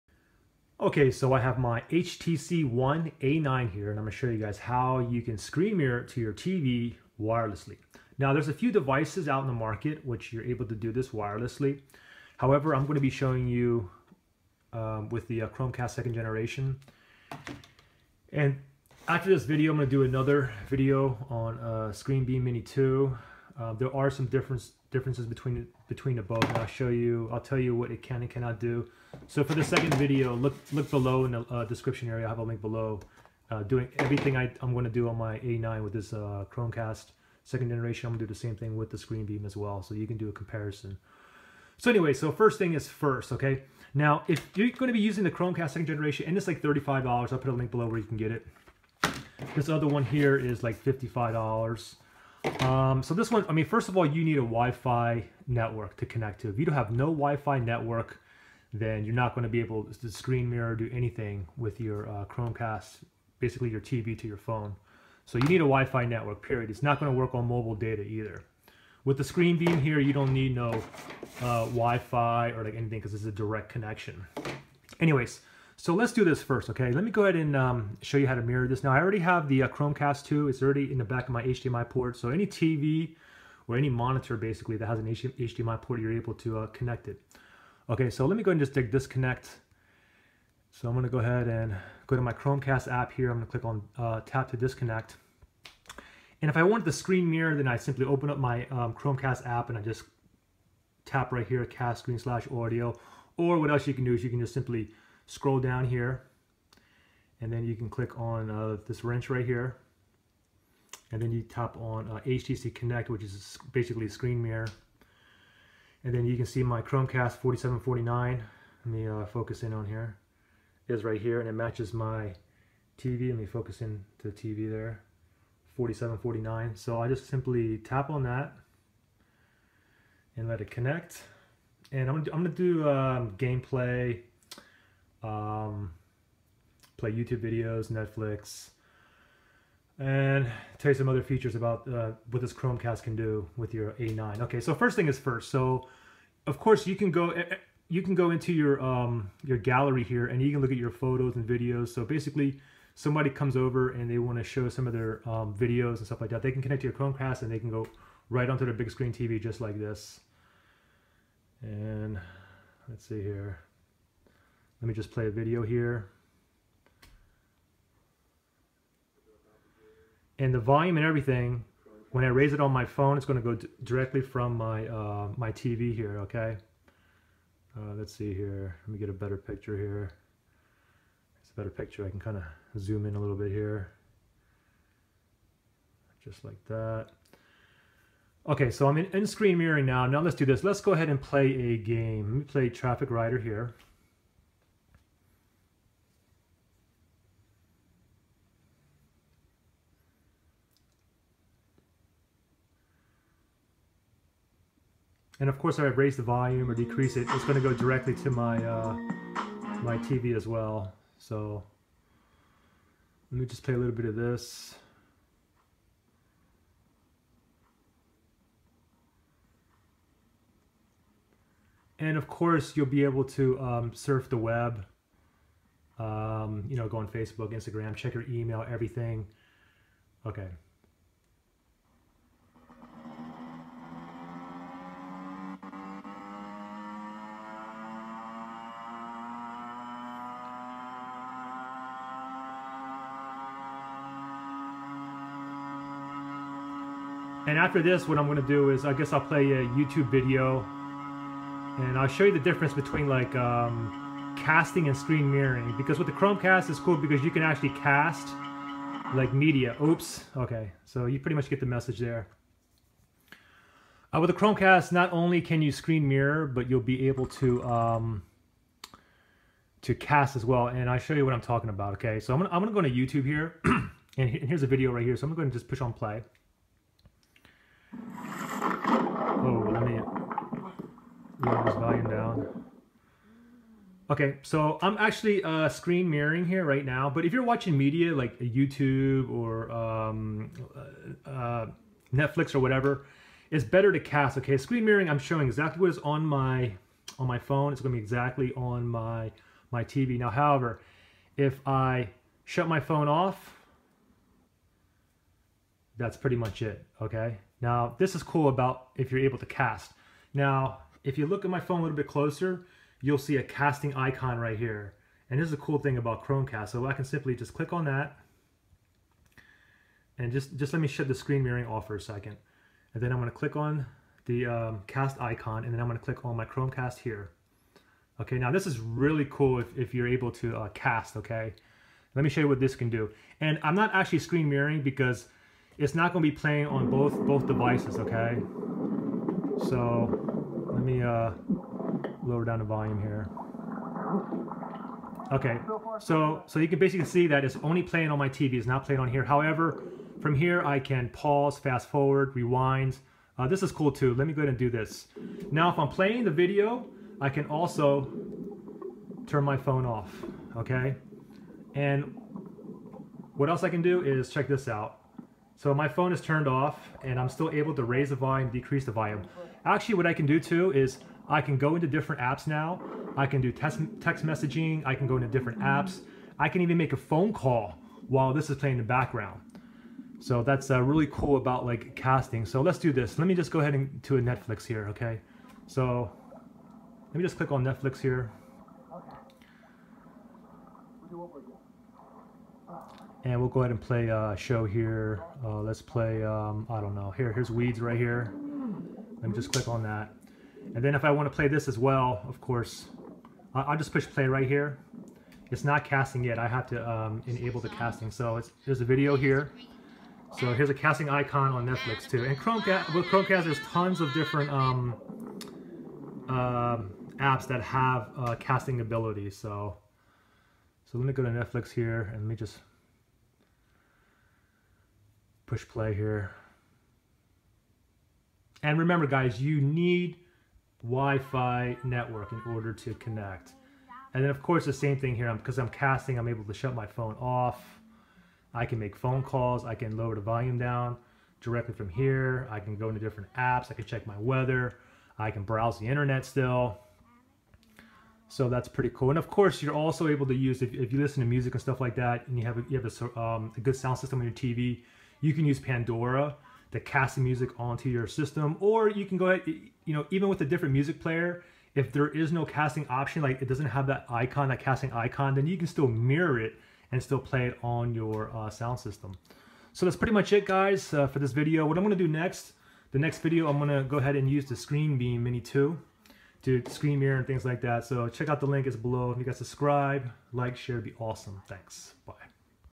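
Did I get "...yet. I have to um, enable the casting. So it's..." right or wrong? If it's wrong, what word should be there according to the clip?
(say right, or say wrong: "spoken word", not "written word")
right.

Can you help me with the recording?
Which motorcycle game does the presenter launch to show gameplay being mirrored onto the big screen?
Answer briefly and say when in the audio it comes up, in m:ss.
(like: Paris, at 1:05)
Traffic Rider, at 3:12.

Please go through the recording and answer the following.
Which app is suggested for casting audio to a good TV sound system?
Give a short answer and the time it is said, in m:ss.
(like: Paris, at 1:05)
Pandora, at 7:35.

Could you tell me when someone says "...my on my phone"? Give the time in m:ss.
4:56.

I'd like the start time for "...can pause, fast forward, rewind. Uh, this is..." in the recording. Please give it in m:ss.
5:50.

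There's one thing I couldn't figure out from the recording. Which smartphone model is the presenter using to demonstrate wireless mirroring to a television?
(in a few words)
HTC One A9.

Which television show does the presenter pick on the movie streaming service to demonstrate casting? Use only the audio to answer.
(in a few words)
Weeds.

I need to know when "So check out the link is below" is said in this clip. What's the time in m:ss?
7:57.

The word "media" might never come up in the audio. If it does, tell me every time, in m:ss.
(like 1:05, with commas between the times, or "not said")
4:19, 4:47.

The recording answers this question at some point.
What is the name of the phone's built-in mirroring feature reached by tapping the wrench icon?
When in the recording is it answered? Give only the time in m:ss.
1:52.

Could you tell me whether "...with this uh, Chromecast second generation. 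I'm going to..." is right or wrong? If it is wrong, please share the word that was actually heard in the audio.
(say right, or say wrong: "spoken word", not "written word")
right.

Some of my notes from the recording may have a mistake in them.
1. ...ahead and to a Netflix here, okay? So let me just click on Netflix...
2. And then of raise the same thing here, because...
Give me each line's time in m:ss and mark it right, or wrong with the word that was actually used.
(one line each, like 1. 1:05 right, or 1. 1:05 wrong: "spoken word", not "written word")
1. 6:23 right
2. 7:14 wrong: "course", not "raise".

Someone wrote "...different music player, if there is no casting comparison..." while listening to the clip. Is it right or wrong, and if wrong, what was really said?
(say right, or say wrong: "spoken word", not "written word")
wrong: "option", not "comparison".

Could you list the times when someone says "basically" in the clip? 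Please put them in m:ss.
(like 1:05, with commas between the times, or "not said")
1:03, 1:24, 1:53, 2:32, 5:46.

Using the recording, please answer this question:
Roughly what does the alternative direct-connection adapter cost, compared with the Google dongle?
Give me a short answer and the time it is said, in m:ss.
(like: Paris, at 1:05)
$55, at 0:50.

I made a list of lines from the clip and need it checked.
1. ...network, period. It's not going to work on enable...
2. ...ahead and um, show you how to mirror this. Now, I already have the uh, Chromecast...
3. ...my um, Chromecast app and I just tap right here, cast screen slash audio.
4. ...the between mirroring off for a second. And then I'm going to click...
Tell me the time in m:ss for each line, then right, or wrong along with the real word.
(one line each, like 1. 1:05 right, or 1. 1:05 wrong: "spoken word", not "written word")
1. 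1:06 wrong: "mobile", not "enable"
2. 1:17 right
3. 1:38 right
4. 5:21 wrong: "screen", not "between".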